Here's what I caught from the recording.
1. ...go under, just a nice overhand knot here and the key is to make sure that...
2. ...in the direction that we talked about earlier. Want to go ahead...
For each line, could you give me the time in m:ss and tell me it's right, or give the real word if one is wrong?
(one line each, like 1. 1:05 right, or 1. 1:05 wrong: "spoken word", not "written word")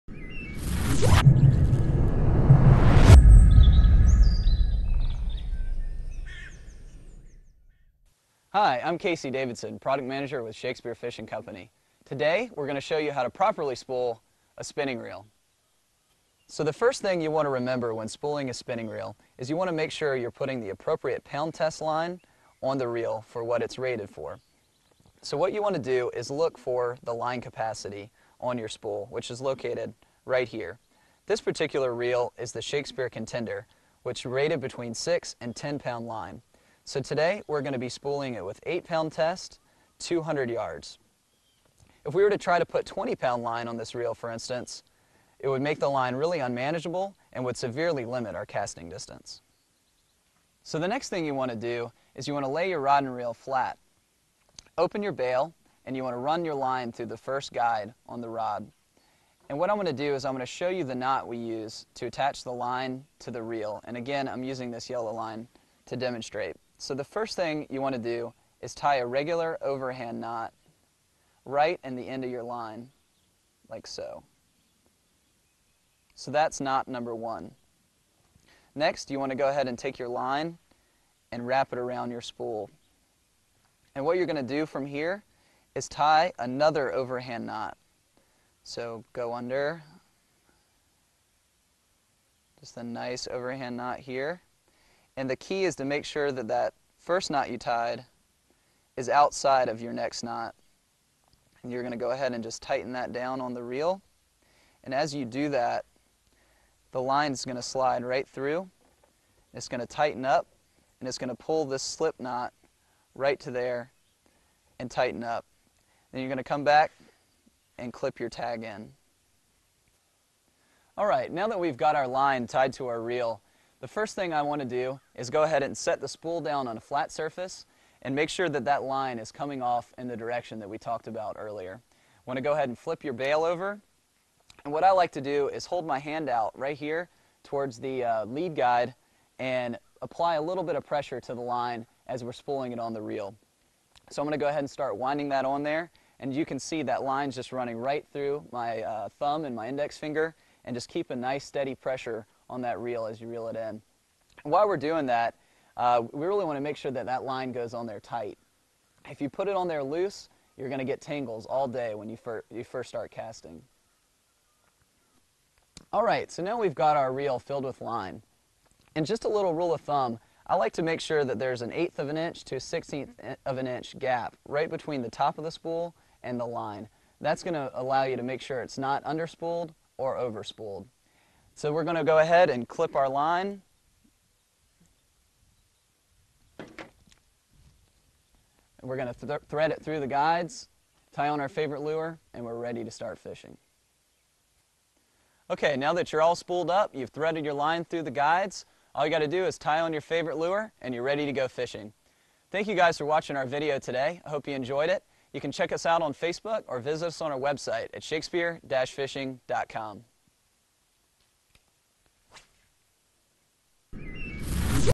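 1. 1:29 right
2. 2:09 right.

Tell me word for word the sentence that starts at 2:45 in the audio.
All right, so now we've got our reel filled with line.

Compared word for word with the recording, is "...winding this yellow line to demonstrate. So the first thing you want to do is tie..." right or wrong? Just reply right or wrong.
wrong.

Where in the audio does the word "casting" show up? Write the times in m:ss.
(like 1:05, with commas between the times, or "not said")
0:48, 2:43.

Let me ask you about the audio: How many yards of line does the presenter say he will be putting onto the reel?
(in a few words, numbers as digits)
200 yards.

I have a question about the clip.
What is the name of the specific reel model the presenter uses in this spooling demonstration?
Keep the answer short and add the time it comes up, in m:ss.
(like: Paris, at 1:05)
Shakespeare Contender, at 0:32.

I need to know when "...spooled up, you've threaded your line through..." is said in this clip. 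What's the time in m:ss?
3:16.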